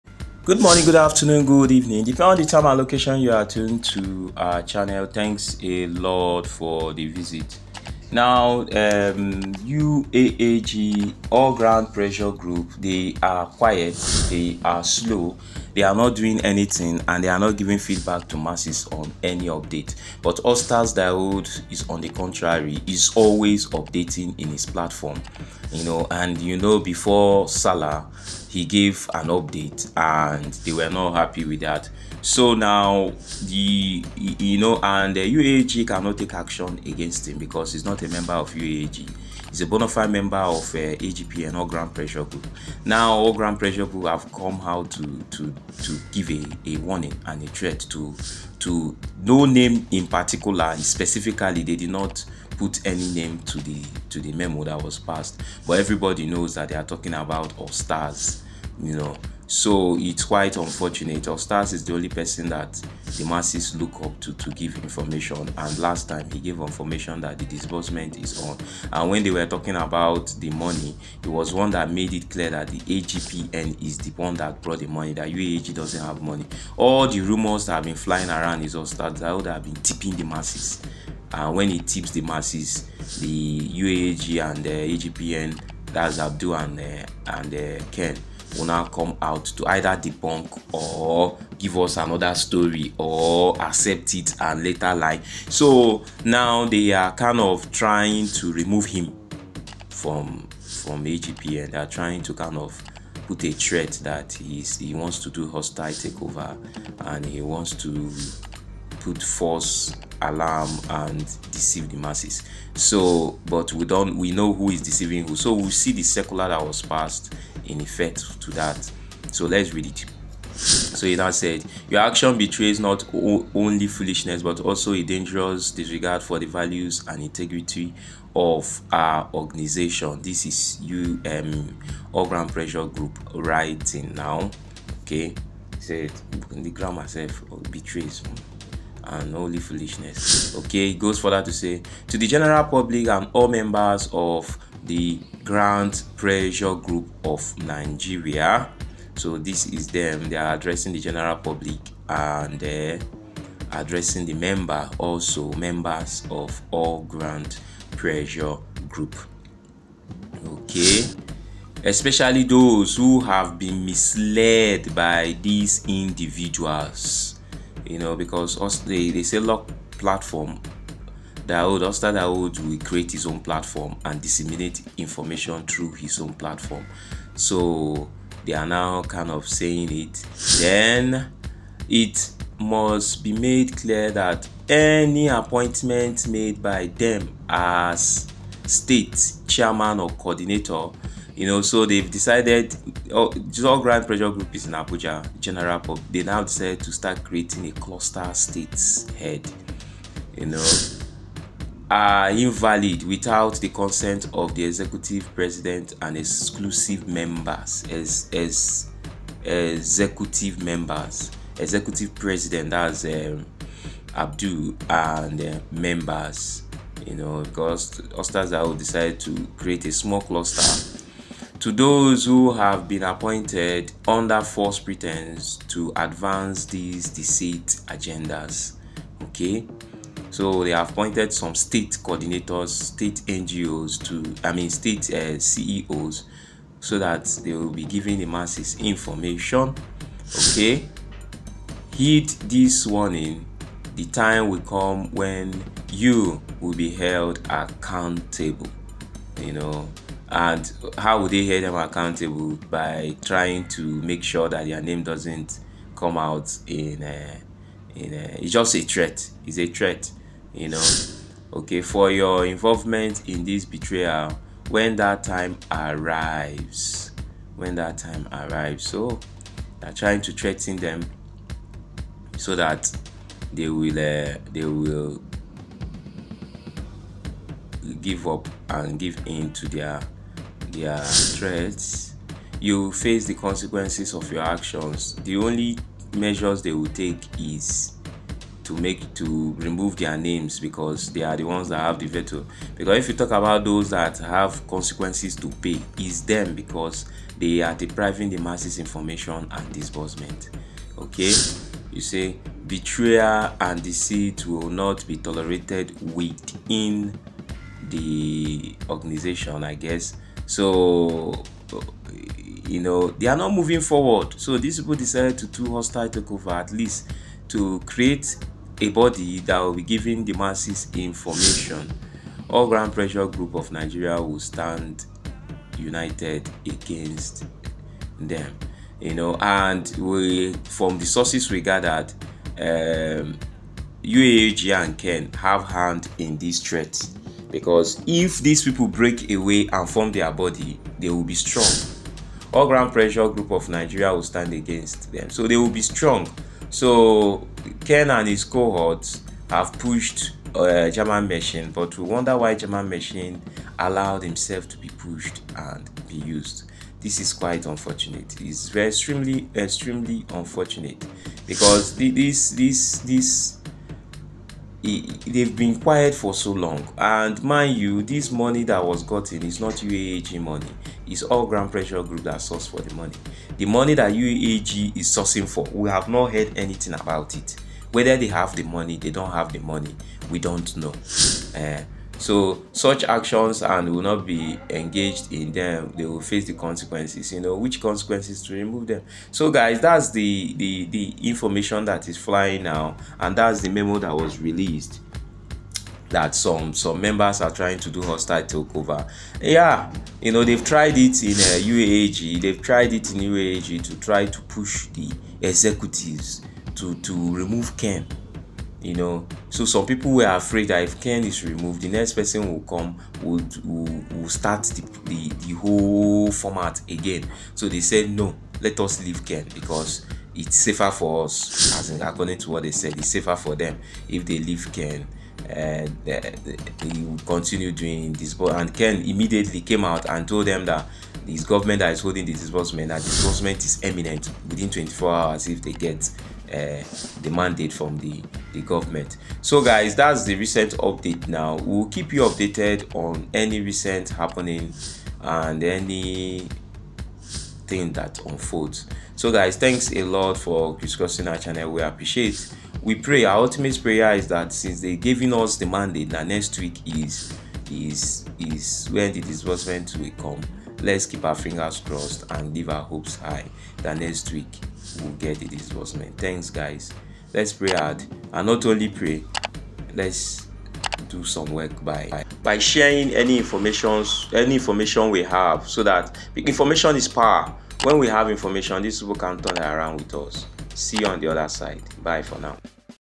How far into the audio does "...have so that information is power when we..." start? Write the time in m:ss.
7:55.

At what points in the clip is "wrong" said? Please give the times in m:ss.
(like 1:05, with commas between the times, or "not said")
not said.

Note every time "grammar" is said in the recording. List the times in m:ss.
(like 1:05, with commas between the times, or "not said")
2:16.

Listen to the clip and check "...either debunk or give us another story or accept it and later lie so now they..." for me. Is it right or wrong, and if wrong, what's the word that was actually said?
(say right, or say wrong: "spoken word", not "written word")
right.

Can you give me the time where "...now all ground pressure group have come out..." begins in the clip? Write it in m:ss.
0:42.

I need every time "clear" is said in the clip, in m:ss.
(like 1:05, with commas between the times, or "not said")
1:12, 3:03.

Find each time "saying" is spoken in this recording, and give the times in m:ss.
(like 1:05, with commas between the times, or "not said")
2:59.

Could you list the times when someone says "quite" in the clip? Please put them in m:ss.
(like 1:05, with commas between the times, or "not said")
1:00, 5:57.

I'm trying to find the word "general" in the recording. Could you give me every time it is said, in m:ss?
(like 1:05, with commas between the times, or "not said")
2:22, 2:30, 3:15.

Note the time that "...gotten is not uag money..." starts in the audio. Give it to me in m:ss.
6:09.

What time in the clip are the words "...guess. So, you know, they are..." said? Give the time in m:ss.
5:09.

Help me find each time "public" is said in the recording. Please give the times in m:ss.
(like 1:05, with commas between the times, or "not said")
2:22, 2:31.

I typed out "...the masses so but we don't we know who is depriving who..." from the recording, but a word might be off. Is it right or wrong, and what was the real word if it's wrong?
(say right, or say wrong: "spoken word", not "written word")
wrong: "deceiving", not "depriving".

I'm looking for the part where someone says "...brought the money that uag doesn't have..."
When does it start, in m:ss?
1:14.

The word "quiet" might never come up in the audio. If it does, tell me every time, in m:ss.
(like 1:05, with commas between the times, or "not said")
0:13, 6:05.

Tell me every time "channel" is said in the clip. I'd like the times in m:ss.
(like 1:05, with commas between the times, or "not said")
0:04, 7:31.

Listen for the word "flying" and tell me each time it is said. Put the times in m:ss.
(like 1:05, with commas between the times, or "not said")
1:17, 6:32.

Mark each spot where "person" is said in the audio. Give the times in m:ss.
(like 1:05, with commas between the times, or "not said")
1:02, 6:52.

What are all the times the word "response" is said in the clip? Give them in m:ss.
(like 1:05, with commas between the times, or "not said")
not said.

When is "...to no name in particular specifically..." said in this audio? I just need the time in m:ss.
0:48.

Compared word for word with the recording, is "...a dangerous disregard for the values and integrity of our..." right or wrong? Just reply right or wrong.
right.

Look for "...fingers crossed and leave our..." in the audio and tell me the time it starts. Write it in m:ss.
7:41.